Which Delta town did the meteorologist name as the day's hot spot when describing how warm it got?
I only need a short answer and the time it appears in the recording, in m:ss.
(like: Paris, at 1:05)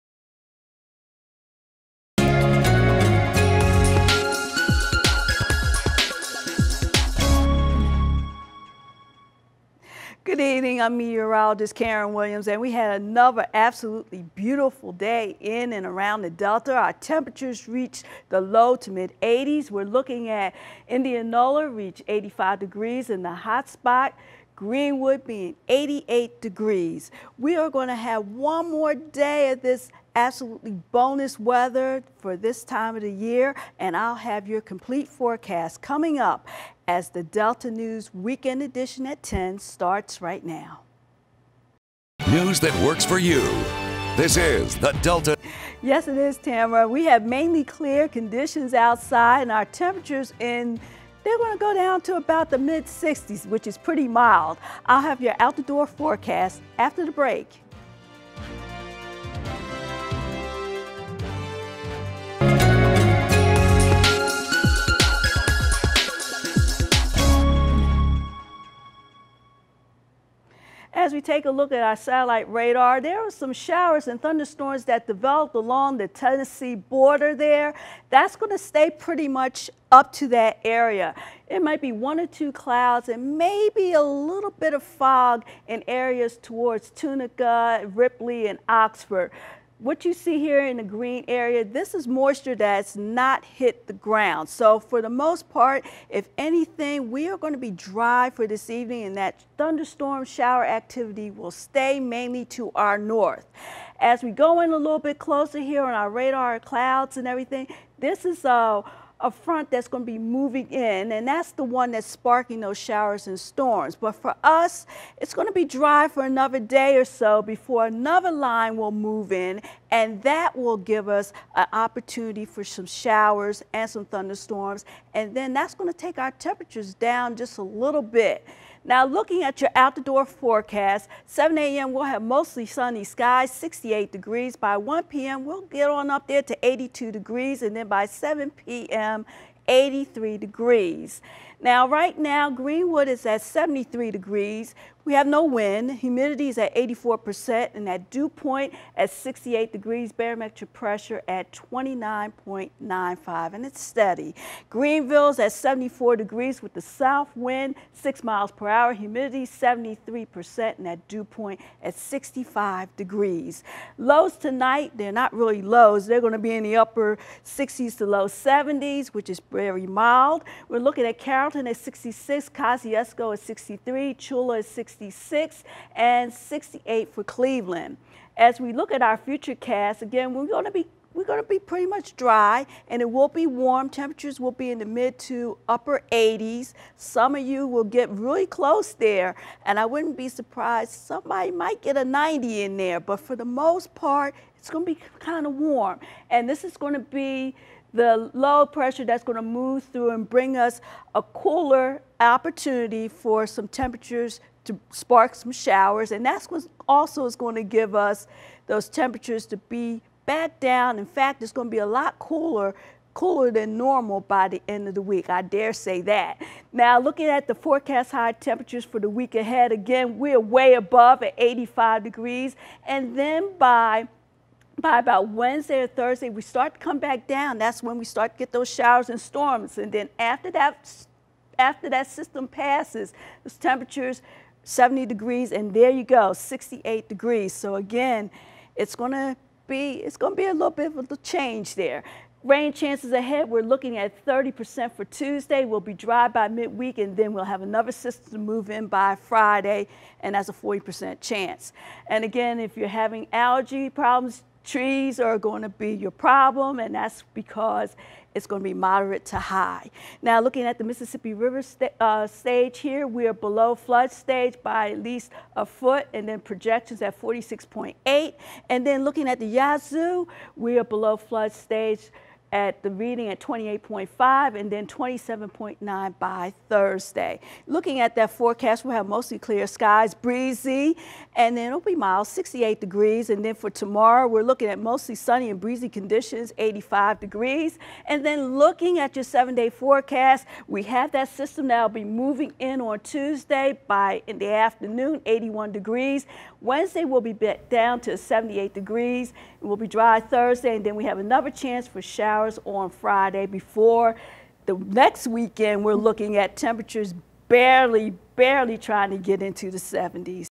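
Indianola, at 0:20.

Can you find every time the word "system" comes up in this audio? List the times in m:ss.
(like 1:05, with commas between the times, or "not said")
3:52, 4:07, 4:51.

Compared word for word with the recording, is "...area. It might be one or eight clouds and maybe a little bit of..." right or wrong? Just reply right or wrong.
wrong.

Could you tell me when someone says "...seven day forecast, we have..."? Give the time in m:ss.
4:49.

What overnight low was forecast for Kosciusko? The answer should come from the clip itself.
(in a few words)
63.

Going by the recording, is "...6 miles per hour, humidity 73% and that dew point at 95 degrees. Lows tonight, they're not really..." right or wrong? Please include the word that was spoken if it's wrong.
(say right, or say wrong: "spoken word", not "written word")
wrong: "65", not "95".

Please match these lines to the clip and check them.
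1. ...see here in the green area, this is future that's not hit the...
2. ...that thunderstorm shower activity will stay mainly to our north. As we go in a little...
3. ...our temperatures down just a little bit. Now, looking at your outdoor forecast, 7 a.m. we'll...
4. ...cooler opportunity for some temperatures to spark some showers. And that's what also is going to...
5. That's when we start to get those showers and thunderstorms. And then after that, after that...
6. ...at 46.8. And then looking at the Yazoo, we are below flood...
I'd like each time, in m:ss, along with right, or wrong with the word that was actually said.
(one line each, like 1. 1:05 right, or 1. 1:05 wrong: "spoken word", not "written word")
1. 1:30 wrong: "moisture", not "future"
2. 1:39 right
3. 2:06 right
4. 3:21 right
5. 3:47 wrong: "storms", not "thunderstorms"
6. 4:27 right.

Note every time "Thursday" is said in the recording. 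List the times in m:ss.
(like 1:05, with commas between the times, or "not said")
3:45, 4:36, 5:00.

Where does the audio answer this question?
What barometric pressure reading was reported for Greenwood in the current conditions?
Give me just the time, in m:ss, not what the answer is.
2:31.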